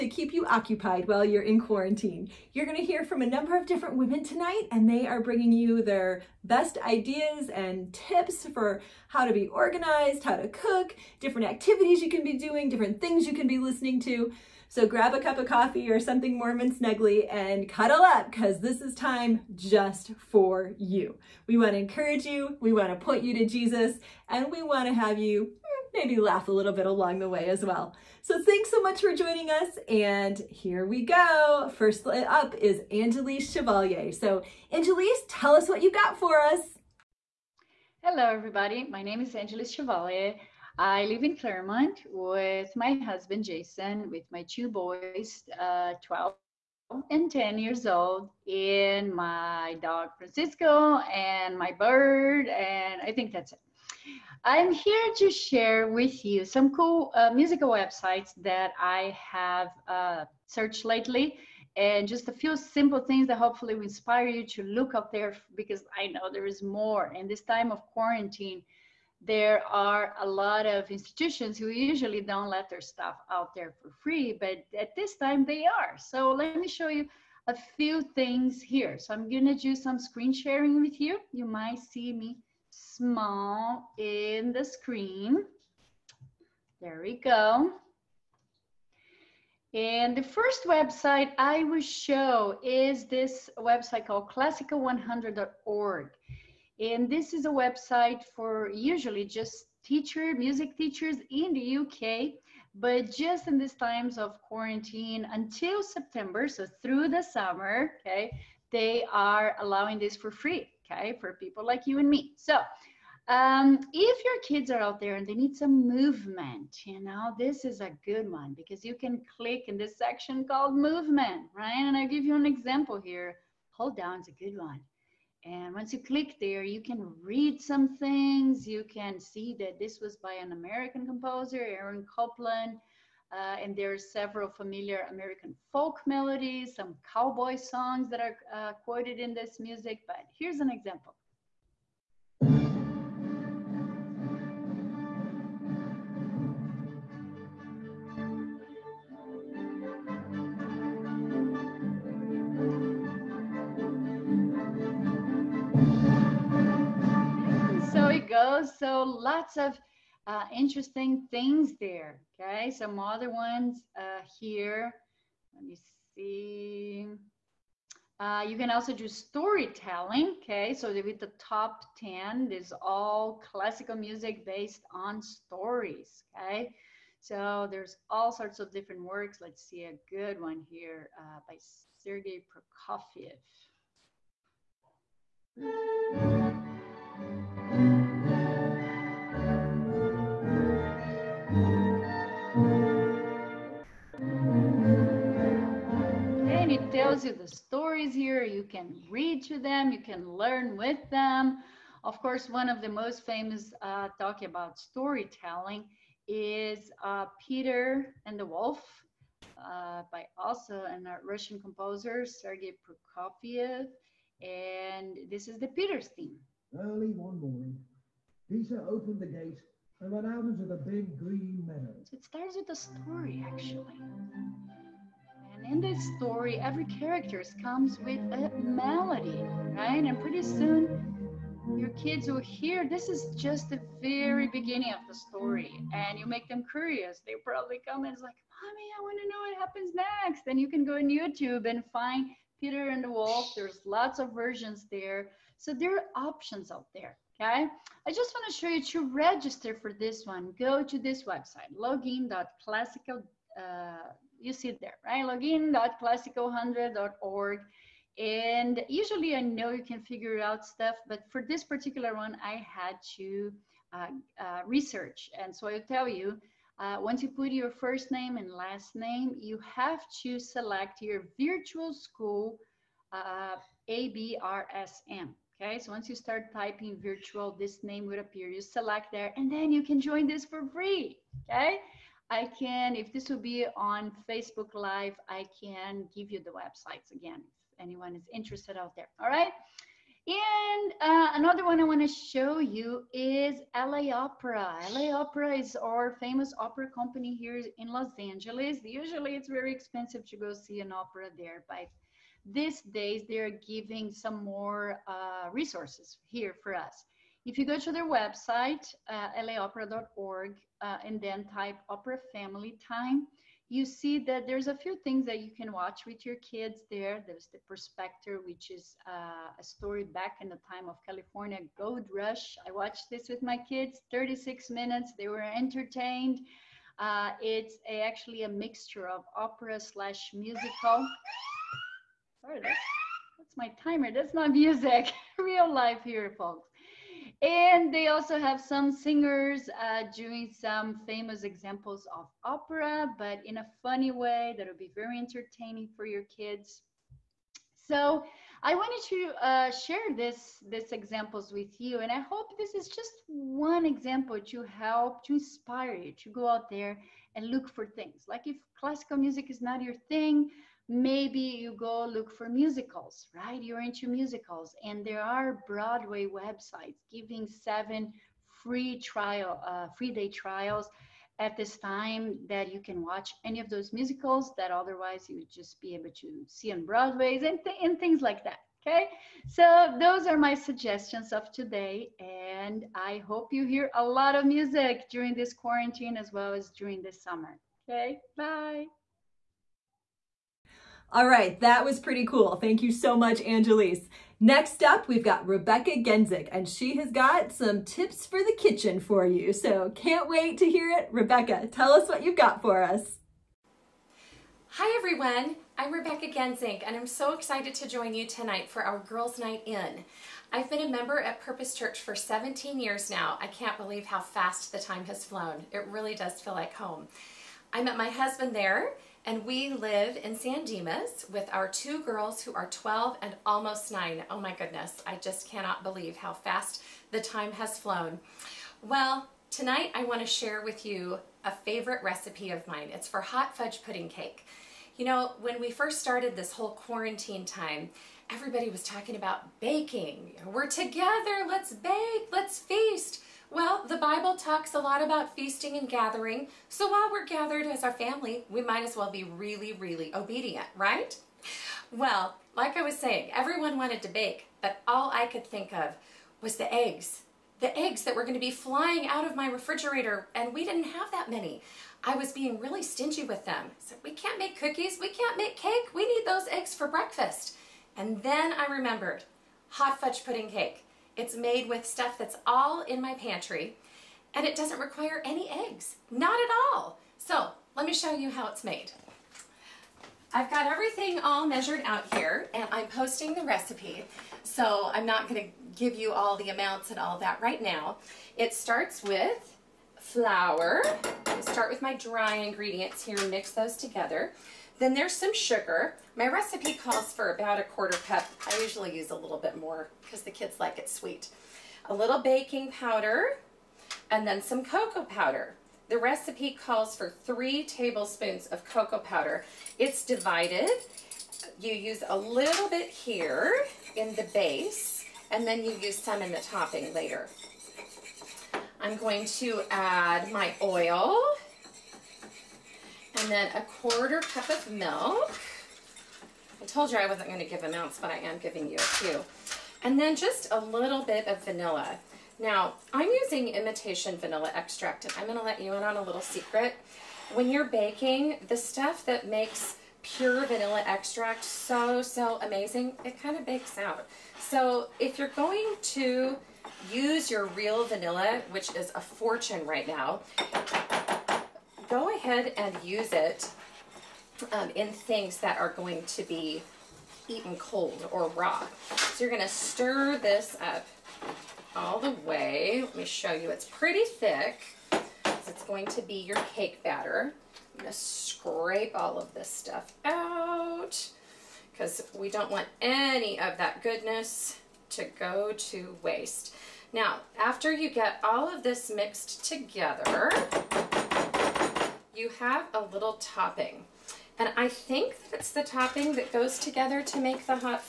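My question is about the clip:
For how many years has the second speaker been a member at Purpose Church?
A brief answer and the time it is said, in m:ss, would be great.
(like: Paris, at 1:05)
17, at 6:52.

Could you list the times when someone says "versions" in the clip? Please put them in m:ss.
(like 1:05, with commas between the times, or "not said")
4:04.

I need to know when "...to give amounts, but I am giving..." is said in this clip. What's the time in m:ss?
8:47.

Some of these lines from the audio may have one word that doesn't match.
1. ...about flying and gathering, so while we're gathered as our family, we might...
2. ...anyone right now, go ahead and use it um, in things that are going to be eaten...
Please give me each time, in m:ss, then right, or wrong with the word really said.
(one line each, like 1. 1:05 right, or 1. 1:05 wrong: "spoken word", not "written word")
1. 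7:25 wrong: "feasting", not "flying"
2. 9:09 wrong: "fortune", not "anyone".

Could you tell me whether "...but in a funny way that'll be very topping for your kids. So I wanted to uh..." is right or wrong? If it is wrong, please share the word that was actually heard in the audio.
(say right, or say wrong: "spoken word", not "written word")
wrong: "entertaining", not "topping".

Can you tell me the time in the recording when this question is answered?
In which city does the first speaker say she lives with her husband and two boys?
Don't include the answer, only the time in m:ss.
0:41.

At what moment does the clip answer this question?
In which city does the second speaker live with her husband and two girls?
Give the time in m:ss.
7:00.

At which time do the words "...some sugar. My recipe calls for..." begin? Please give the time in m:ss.
8:15.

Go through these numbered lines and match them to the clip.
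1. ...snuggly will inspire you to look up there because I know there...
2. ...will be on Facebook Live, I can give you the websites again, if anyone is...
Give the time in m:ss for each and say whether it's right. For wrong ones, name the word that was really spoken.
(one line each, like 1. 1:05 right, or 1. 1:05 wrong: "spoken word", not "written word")
1. 1:03 wrong: "hopefully", not "snuggly"
2. 4:43 right.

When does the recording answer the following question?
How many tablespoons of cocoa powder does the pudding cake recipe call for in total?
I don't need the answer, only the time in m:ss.
8:27.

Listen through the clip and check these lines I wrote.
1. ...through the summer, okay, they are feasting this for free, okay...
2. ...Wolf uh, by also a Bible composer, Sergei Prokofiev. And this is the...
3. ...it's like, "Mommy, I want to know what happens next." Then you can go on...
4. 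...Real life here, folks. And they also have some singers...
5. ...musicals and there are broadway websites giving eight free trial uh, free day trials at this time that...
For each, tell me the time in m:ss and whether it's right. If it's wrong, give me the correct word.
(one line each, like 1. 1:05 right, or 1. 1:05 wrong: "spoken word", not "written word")
1. 1:46 wrong: "allowing", not "feasting"
2. 3:28 wrong: "Russian", not "Bible"
3. 3:58 right
4. 5:35 right
5. 6:04 wrong: "seven", not "eight".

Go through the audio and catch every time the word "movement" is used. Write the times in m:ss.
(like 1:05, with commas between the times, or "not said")
1:55, 2:00.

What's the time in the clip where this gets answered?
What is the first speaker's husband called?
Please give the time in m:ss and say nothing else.
0:43.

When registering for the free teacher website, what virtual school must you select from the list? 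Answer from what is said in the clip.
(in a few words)
ABRSM.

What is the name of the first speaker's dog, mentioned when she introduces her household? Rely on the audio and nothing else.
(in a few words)
Francisco.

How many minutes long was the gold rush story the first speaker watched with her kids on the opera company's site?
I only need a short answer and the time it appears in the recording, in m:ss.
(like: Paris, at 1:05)
36, at 5:24.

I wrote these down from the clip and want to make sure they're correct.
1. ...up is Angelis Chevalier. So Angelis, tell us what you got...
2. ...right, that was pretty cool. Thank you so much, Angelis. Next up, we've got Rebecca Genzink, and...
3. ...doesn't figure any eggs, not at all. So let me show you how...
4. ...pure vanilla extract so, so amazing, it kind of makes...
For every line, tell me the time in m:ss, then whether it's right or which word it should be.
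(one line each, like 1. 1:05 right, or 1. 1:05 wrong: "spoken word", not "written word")
1. 0:32 right
2. 6:31 right
3. 7:54 wrong: "require", not "figure"
4. 9:00 wrong: "bakes", not "makes".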